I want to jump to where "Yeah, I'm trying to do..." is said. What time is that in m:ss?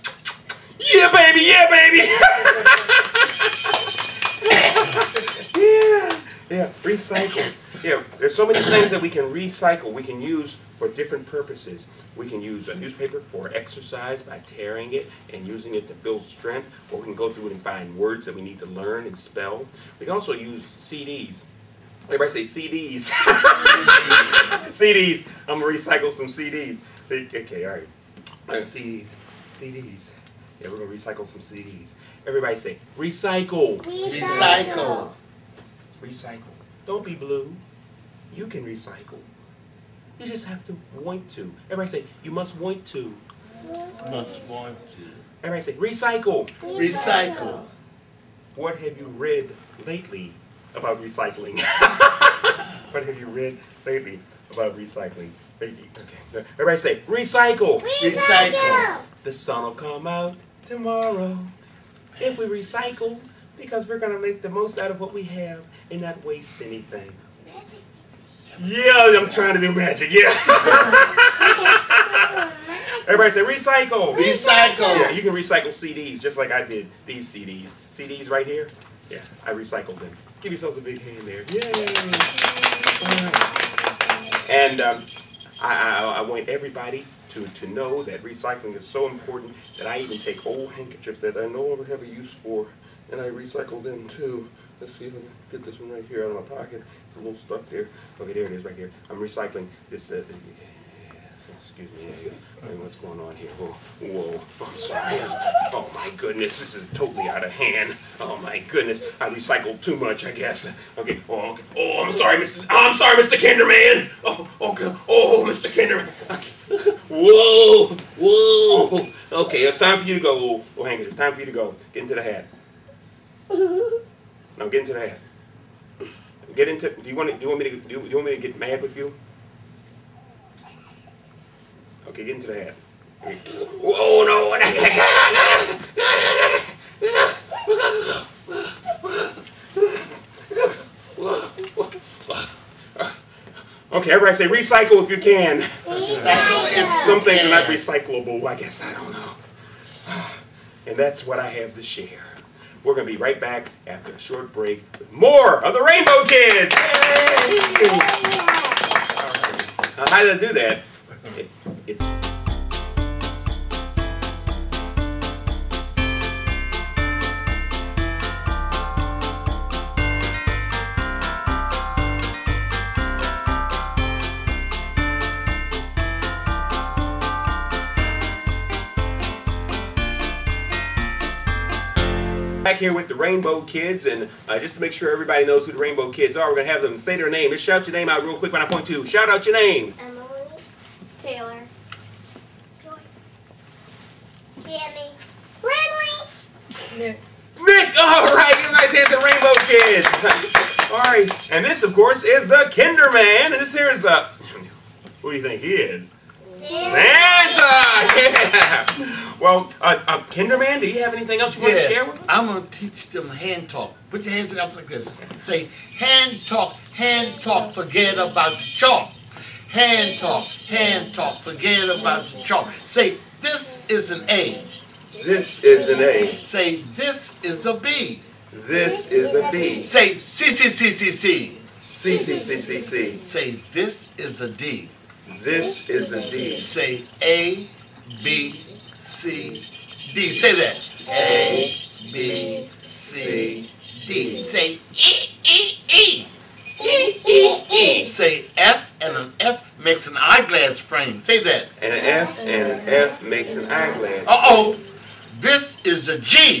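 1:08.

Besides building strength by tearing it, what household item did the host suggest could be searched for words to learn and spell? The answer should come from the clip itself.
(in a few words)
Newspaper.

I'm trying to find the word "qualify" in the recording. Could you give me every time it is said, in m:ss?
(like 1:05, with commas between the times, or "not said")
not said.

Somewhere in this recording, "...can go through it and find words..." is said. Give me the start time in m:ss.
0:17.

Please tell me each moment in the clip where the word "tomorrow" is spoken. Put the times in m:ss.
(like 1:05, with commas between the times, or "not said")
1:00.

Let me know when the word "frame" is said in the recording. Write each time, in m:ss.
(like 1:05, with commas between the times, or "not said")
4:10.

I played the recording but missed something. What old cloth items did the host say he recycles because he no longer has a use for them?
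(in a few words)
Handkerchiefs.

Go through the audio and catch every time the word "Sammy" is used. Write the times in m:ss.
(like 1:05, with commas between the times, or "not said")
3:14.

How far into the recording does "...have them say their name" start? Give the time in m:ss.
3:06.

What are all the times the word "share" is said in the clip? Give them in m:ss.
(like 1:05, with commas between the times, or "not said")
2:31, 3:31.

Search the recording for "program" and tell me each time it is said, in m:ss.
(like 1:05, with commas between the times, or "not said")
not said.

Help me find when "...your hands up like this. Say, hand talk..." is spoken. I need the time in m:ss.
3:34.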